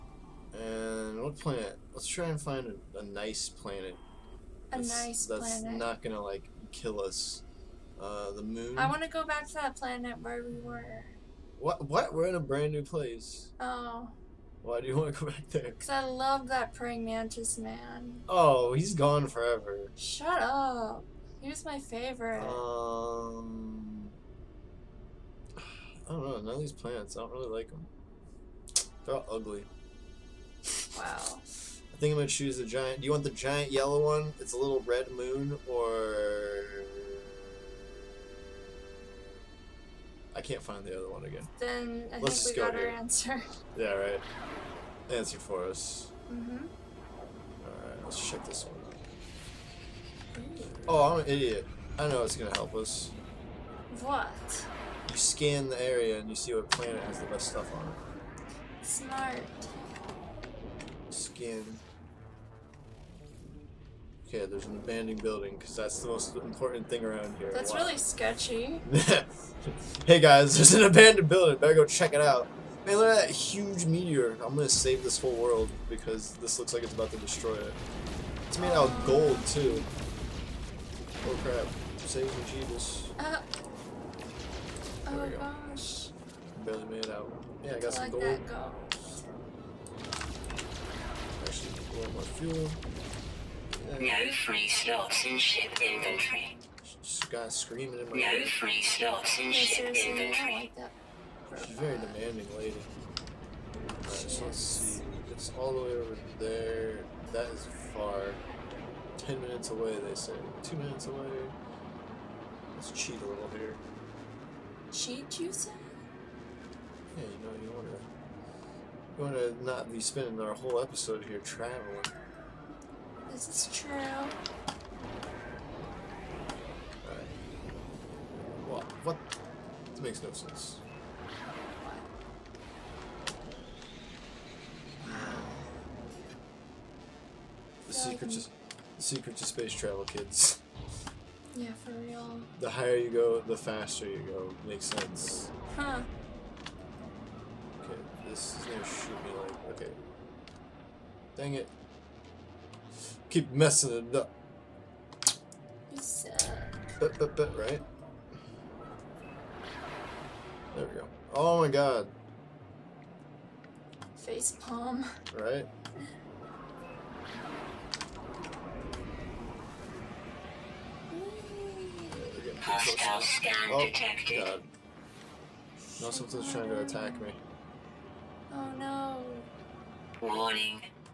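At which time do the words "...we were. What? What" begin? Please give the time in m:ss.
0:10.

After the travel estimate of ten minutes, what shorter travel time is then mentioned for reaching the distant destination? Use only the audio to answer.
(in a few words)
2 minutes.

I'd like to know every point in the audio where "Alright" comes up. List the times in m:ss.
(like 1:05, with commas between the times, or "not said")
0:47, 1:43.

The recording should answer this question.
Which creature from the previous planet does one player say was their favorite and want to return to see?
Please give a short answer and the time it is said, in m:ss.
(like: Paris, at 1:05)
Praying mantis man, at 0:16.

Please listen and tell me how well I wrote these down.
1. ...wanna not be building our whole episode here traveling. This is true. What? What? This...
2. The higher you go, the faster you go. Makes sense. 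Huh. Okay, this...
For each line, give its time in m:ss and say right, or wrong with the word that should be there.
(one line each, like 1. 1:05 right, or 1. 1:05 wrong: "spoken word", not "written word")
1. 1:59 wrong: "spending", not "building"
2. 2:22 right.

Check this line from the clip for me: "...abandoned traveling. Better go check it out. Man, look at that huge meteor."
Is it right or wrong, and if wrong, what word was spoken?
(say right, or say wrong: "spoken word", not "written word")
wrong: "building", not "traveling".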